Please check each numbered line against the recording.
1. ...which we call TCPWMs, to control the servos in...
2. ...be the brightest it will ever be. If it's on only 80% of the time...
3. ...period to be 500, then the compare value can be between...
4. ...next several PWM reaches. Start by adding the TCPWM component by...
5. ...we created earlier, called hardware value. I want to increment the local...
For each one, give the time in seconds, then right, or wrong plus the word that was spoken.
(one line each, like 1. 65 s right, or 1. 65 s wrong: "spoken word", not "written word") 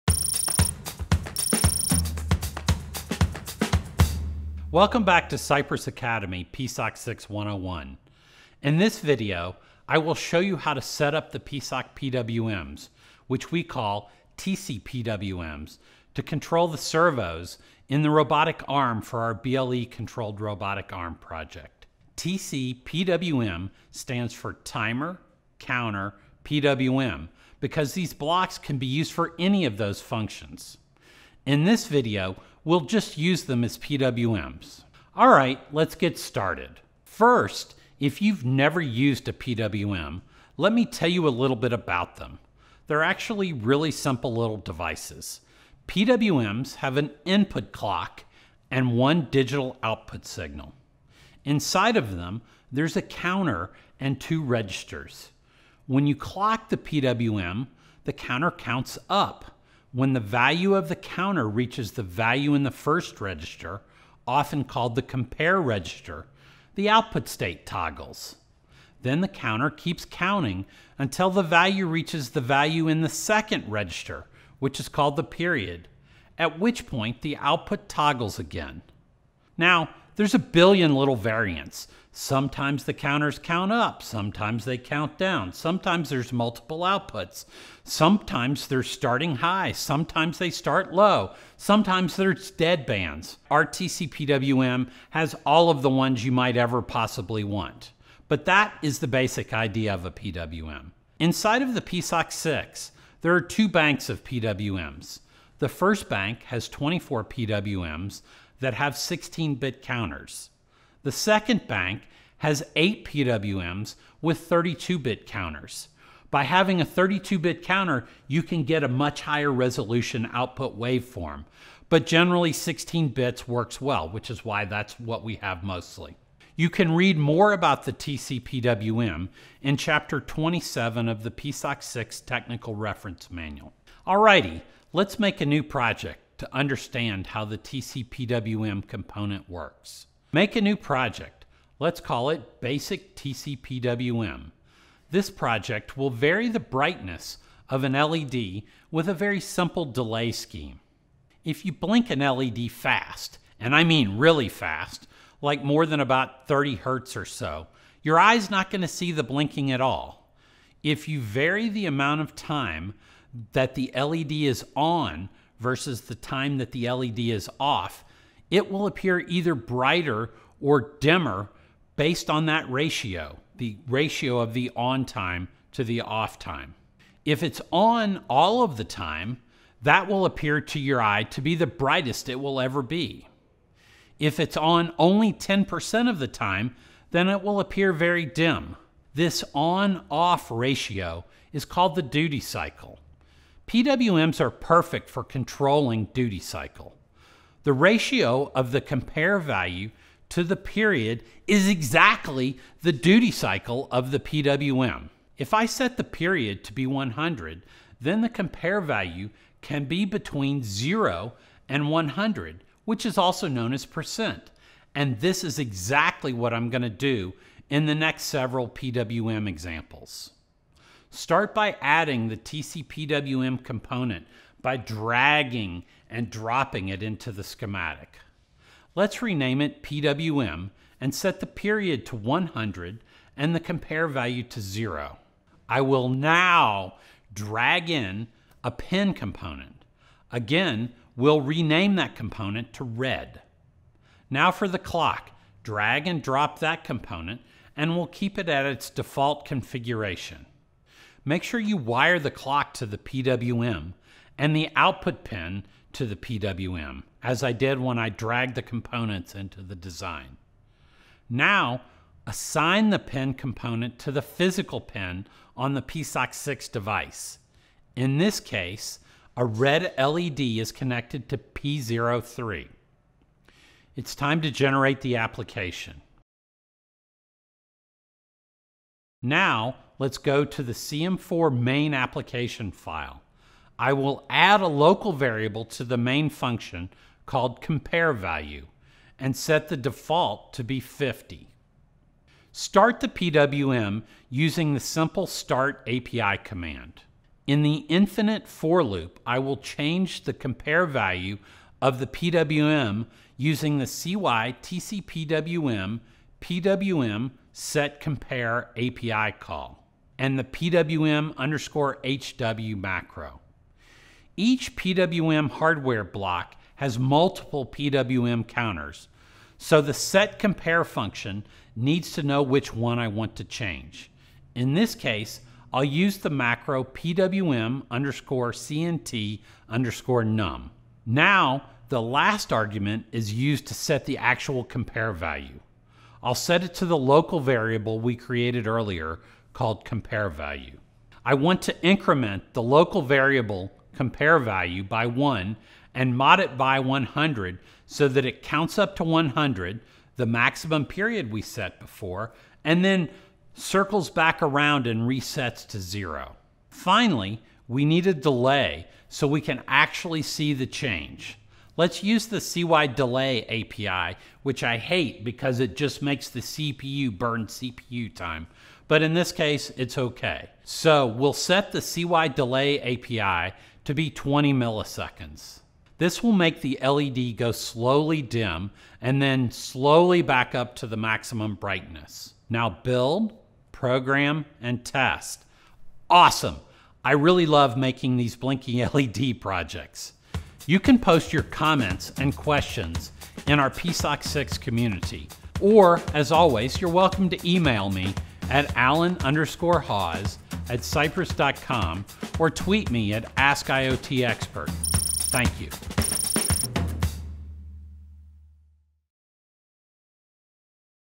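1. 13 s right
2. 181 s wrong: "10", not "80"
3. 206 s wrong: "100", not "500"
4. 217 s wrong: "examples", not "reaches"
5. 337 s wrong: "compare", not "hardware".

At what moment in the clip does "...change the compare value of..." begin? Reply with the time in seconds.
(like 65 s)
299 s.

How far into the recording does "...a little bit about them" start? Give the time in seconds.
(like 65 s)
41 s.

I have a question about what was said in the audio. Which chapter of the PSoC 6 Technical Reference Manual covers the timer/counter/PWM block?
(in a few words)
Chapter 27.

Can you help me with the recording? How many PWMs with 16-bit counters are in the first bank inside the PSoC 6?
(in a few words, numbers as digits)
24.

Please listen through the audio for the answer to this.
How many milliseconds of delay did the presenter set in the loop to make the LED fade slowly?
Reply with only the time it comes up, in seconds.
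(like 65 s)
374 s.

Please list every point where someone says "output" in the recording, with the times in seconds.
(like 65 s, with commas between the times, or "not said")
49 s, 66 s, 77 s, 86 s, 120 s, 254 s.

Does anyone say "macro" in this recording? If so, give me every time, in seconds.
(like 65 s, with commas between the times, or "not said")
312 s, 326 s.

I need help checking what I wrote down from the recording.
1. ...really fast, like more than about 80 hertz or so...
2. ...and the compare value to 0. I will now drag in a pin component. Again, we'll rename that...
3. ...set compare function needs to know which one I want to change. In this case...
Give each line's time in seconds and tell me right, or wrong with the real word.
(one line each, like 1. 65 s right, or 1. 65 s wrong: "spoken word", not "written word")
1. 154 s wrong: "30", not "80"
2. 233 s right
3. 319 s right.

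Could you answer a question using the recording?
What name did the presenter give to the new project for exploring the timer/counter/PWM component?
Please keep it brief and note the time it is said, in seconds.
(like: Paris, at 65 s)
Basic TCPWM, at 142 s.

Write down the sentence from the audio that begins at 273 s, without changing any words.
It's time to generate the application.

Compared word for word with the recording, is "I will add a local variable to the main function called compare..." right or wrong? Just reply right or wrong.
right.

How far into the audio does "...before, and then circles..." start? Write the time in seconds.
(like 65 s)
351 s.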